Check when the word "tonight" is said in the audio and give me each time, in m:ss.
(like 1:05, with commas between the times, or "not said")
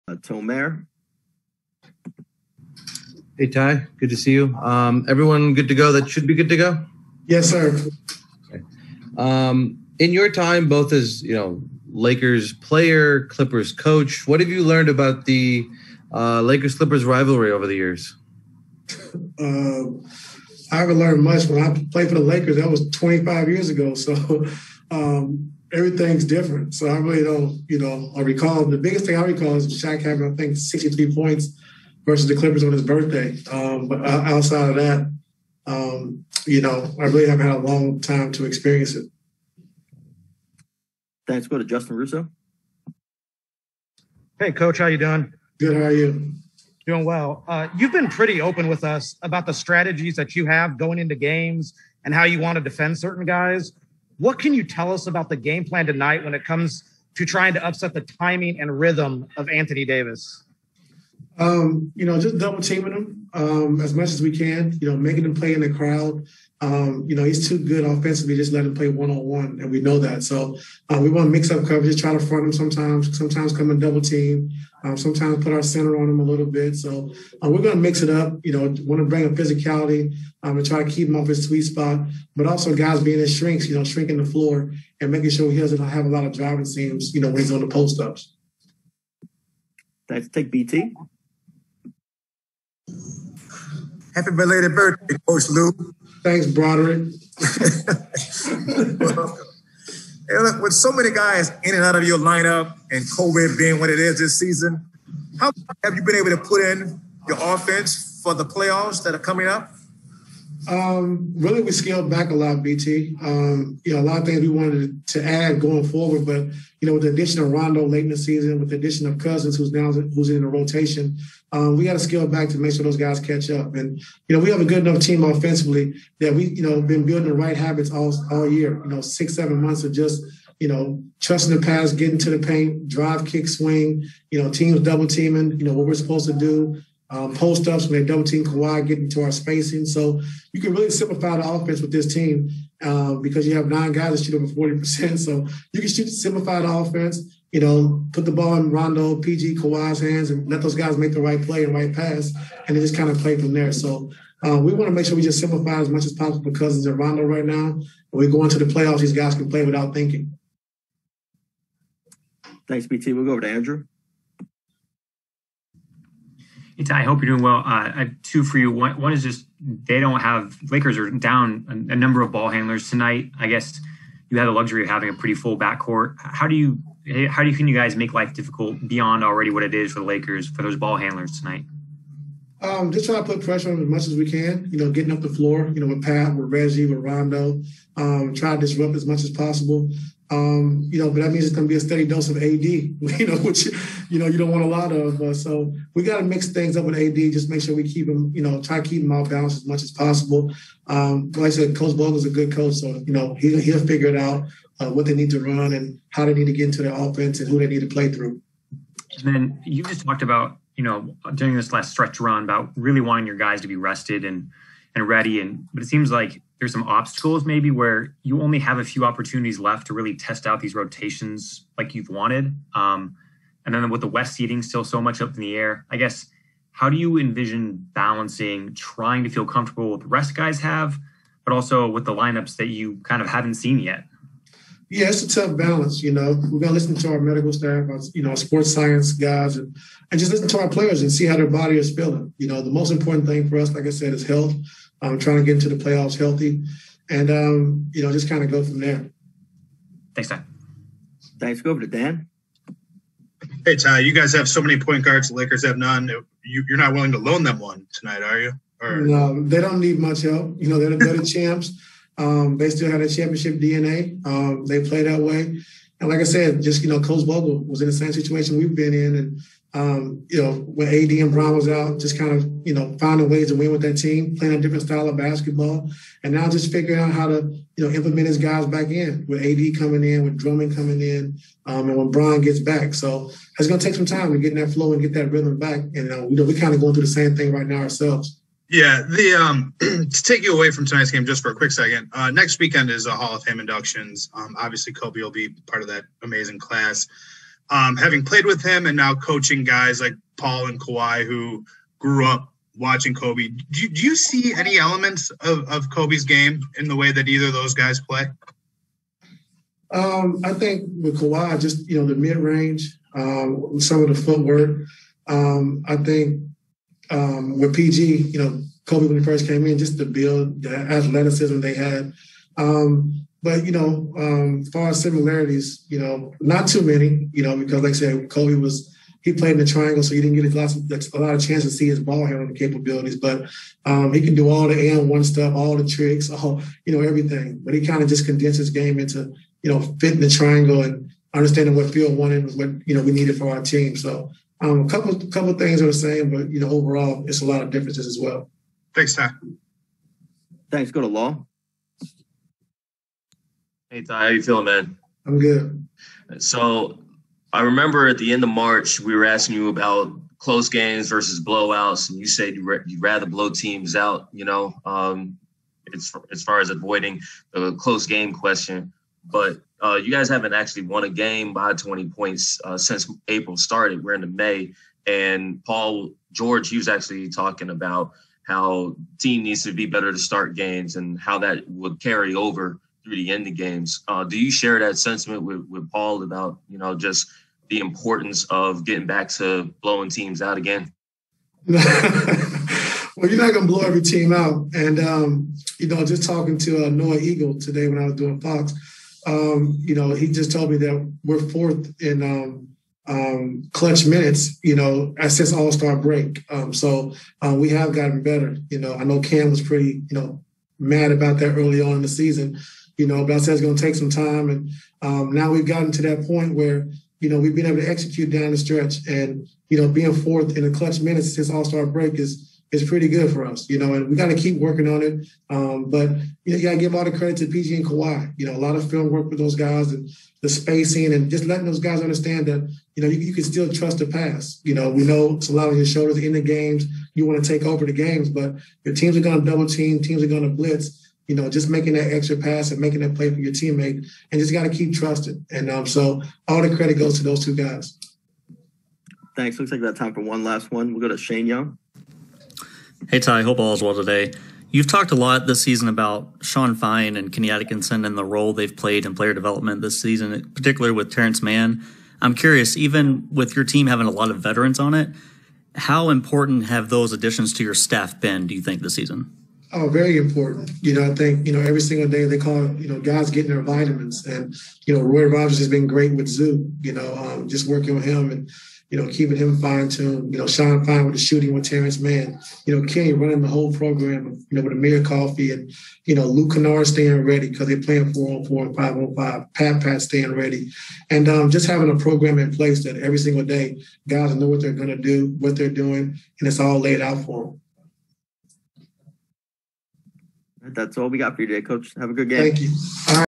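0:55, 2:52, 3:01, 4:17, 4:50.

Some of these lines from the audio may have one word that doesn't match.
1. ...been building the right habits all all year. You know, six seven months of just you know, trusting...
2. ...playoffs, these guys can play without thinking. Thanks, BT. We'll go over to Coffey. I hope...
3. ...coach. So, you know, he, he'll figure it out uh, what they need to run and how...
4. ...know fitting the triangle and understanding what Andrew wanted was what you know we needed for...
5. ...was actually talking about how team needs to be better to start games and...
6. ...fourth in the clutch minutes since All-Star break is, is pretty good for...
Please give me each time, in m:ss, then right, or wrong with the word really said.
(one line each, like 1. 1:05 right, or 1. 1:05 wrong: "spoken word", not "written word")
1. 2:06 right
2. 2:38 wrong: "Andrew", not "Coffey"
3. 3:22 right
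4. 5:39 wrong: "Phil", not "Andrew"
5. 6:16 right
6. 7:00 right.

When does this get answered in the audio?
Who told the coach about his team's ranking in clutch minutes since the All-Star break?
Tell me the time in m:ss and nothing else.
6:36.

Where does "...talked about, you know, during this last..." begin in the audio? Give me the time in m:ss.
3:30.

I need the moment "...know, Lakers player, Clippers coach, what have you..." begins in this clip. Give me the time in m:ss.
0:11.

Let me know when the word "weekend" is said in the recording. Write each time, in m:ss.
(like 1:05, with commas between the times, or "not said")
4:52.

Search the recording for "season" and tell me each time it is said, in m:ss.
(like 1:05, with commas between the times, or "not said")
1:44, 1:58, 6:52, 7:35, 7:40, 7:48.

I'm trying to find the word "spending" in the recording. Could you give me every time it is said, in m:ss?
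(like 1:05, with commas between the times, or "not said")
not said.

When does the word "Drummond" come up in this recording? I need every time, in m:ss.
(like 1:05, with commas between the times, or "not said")
4:40.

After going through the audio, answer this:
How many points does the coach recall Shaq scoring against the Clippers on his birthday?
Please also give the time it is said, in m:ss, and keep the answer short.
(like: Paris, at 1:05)
63, at 0:30.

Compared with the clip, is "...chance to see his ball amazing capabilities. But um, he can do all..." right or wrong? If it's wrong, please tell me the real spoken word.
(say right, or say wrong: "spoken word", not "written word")
wrong: "handling", not "amazing".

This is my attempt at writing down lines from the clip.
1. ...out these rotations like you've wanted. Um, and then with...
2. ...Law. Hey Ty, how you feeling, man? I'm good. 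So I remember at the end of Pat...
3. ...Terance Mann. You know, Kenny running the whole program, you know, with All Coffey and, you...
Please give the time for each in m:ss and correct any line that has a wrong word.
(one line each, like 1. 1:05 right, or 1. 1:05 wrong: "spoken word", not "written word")
1. 3:40 right
2. 5:51 wrong: "March", not "Pat"
3. 8:01 wrong: "Amir", not "All".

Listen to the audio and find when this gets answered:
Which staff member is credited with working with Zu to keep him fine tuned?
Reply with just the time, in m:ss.
7:55.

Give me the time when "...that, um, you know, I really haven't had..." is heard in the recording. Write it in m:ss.
0:34.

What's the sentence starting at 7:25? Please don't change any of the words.
And um, so all the credit goes to those two guys.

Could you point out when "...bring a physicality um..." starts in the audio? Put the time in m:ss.
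1:19.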